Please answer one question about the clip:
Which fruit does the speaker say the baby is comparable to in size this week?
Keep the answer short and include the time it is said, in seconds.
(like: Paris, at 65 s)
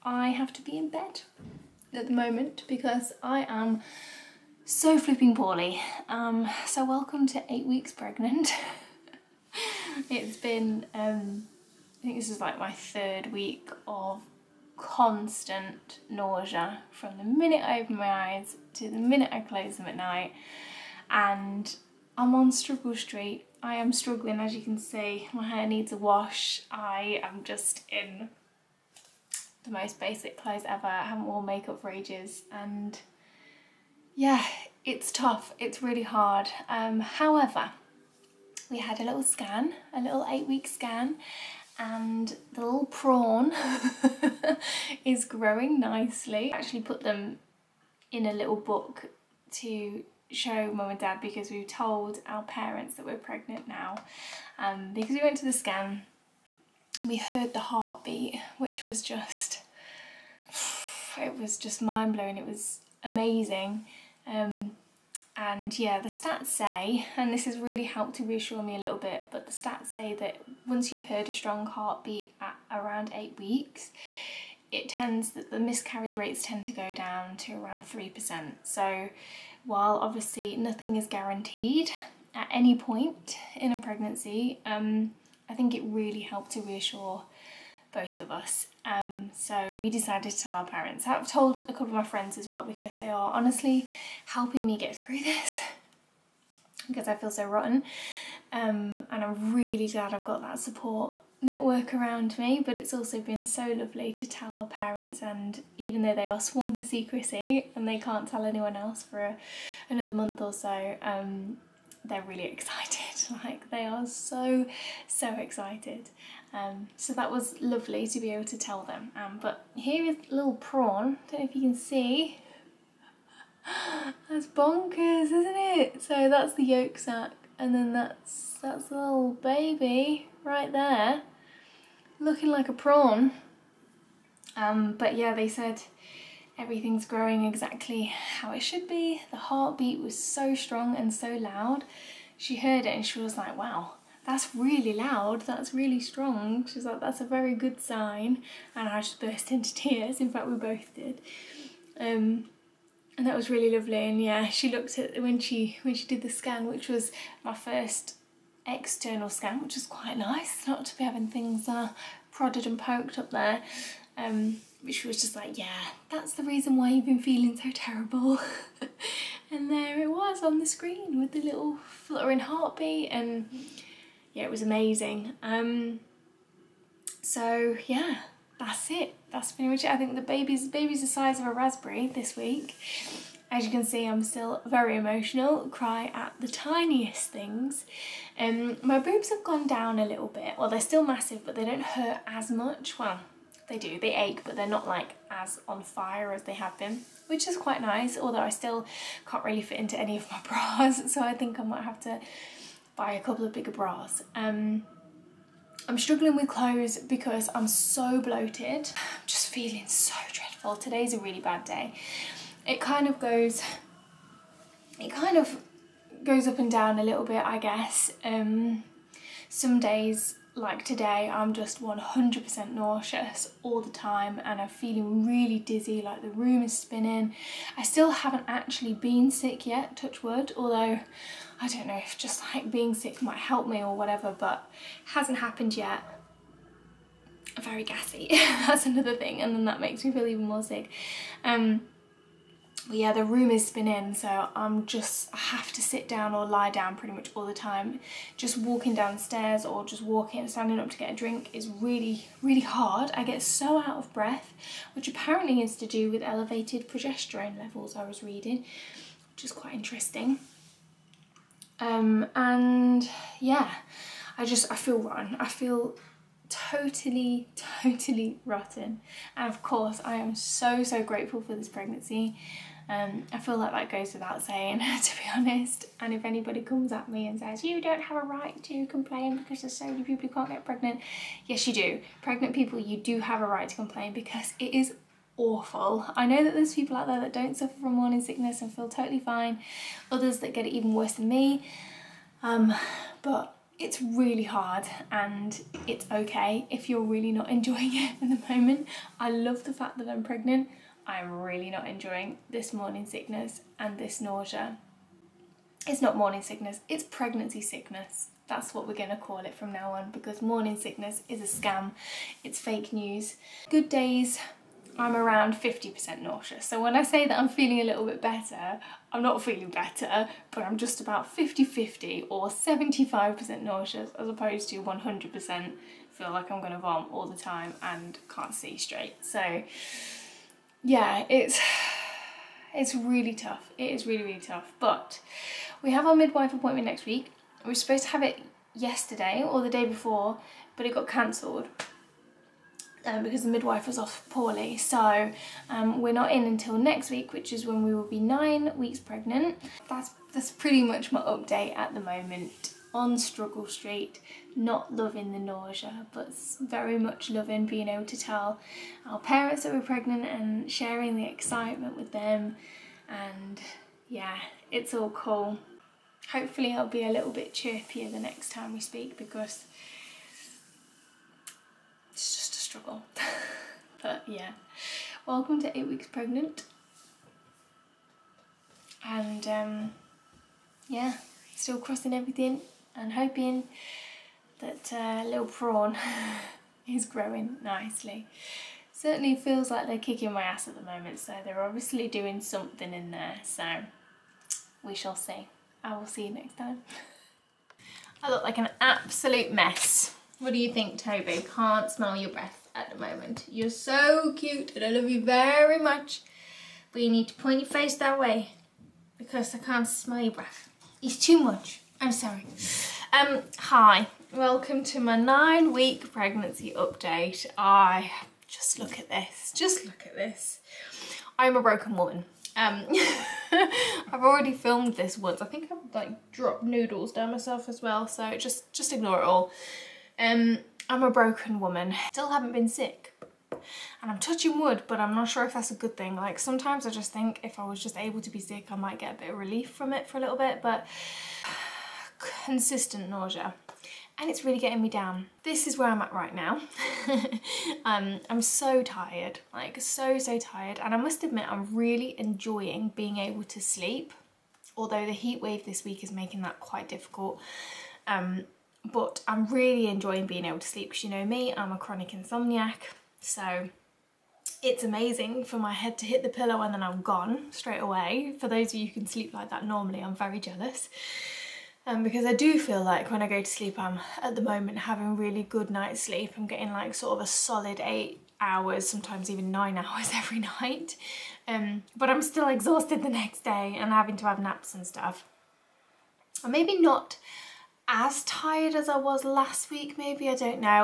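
raspberry, at 181 s.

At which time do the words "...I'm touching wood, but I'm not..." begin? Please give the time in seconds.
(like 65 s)
434 s.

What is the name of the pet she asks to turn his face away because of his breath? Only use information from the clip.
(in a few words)
Toby.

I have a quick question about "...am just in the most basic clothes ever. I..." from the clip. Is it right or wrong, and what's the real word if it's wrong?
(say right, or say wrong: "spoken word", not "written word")
right.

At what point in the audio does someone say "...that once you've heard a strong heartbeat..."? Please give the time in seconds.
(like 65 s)
70 s.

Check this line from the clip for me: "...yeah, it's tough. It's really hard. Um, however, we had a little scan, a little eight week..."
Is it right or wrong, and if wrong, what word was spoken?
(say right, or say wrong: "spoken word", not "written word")
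right.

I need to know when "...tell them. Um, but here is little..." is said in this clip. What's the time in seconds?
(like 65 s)
118 s.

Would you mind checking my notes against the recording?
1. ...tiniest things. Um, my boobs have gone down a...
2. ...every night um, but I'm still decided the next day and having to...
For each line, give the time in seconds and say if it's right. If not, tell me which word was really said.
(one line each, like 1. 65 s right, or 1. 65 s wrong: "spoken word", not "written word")
1. 186 s right
2. 480 s wrong: "exhausted", not "decided".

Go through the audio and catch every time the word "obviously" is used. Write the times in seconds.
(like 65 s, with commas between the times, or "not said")
79 s, 391 s.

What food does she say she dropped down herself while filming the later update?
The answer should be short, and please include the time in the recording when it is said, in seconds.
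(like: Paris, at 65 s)
noodles, at 426 s.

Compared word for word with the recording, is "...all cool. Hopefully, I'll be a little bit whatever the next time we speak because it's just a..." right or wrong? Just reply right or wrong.
wrong.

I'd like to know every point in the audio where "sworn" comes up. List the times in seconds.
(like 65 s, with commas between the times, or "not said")
106 s.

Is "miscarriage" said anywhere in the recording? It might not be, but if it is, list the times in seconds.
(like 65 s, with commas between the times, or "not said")
75 s.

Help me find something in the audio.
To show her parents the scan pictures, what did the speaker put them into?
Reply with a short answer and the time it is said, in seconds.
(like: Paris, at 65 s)
a little book, at 48 s.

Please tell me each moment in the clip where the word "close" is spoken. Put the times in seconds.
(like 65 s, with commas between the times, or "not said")
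19 s.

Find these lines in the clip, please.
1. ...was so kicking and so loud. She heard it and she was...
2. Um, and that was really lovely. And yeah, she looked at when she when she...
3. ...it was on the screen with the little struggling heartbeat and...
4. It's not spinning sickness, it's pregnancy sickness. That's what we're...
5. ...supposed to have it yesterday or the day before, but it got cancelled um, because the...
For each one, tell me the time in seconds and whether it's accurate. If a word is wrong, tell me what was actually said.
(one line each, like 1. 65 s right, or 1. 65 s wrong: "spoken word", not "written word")
1. 139 s wrong: "strong", not "kicking"
2. 151 s right
3. 170 s wrong: "fluttering", not "struggling"
4. 305 s wrong: "morning", not "spinning"
5. 337 s right.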